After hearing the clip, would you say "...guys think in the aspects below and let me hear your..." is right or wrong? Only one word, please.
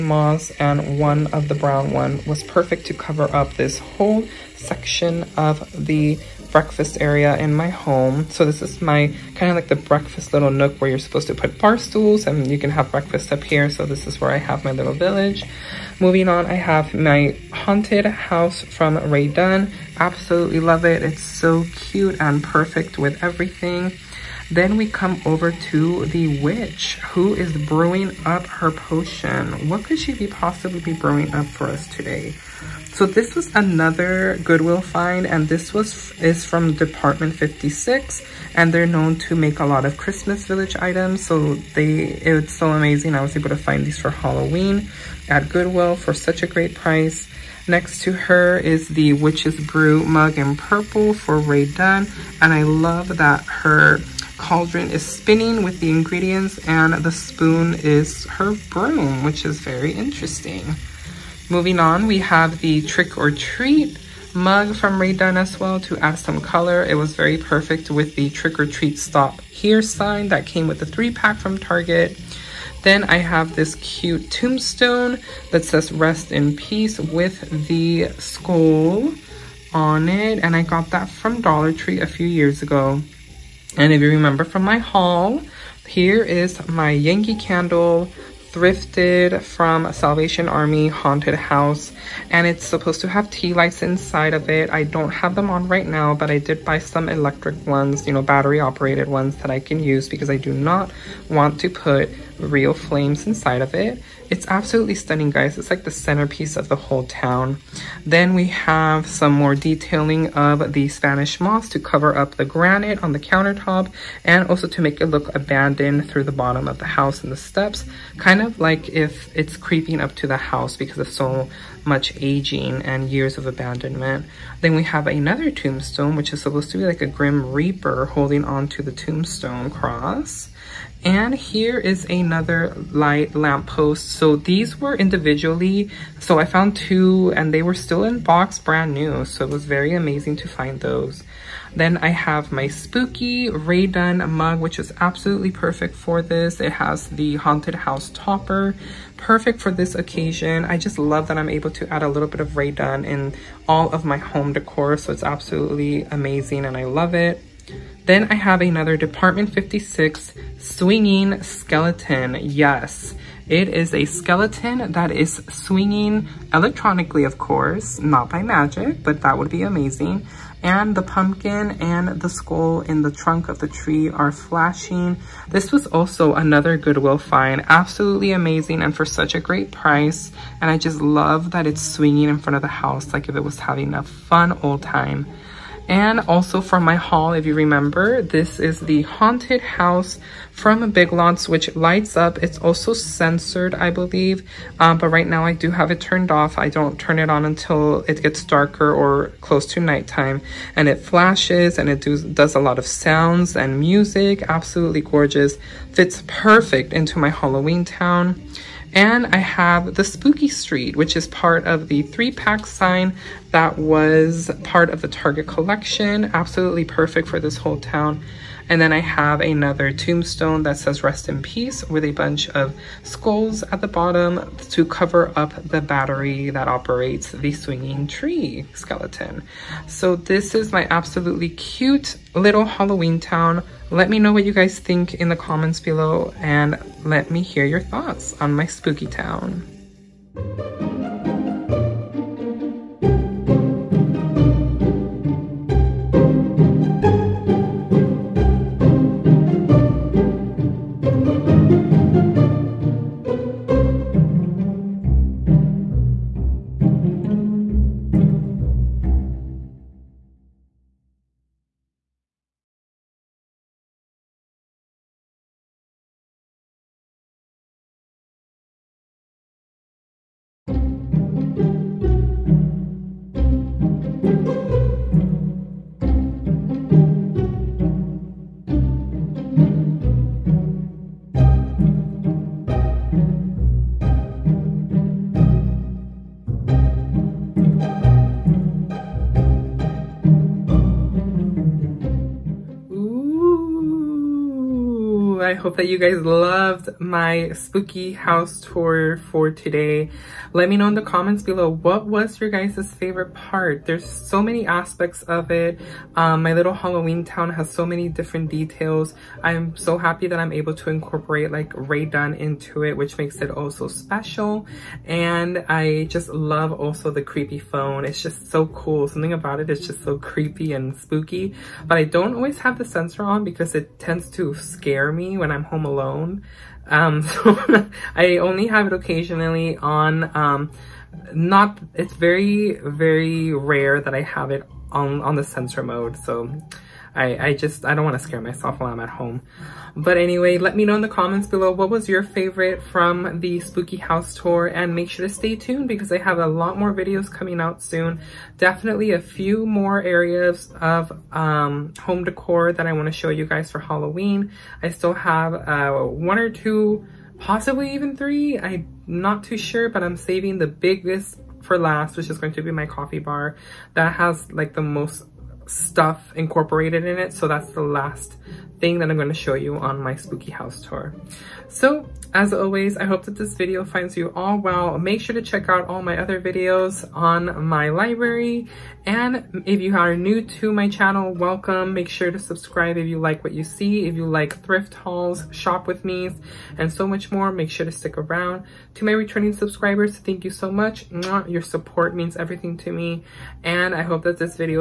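wrong.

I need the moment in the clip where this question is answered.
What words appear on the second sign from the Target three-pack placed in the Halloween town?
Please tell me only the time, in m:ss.
3:30.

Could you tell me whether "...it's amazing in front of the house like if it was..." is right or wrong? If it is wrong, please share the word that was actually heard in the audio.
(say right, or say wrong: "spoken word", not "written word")
wrong: "swinging", not "amazing".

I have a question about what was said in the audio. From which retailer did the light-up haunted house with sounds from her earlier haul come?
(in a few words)
Big Lots.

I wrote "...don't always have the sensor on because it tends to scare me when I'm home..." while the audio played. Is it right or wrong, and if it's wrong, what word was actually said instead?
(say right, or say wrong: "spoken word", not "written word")
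right.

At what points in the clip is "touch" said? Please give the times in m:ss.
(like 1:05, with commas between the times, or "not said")
not said.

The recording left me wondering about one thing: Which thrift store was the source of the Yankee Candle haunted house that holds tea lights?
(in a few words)
Salvation Army.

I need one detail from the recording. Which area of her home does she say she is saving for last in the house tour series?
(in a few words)
coffee bar.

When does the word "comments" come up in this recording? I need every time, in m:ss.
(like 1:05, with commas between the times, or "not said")
3:55, 5:01, 5:41.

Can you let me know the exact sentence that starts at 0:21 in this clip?
It's so cute and perfect with everything.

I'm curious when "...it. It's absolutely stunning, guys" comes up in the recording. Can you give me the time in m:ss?
1:43.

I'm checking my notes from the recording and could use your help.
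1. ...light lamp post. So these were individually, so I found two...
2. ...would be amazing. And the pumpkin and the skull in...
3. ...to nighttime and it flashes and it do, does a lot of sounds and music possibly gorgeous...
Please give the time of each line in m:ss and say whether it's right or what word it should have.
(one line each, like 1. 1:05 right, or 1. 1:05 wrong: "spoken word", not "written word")
1. 2:12 right
2. 2:49 right
3. 3:19 wrong: "absolutely", not "possibly".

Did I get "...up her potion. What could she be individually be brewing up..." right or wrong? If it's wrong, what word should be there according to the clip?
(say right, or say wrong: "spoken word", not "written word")
wrong: "possibly", not "individually".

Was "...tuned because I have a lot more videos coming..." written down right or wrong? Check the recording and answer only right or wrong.
right.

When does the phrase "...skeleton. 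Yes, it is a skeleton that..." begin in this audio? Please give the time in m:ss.
2:41.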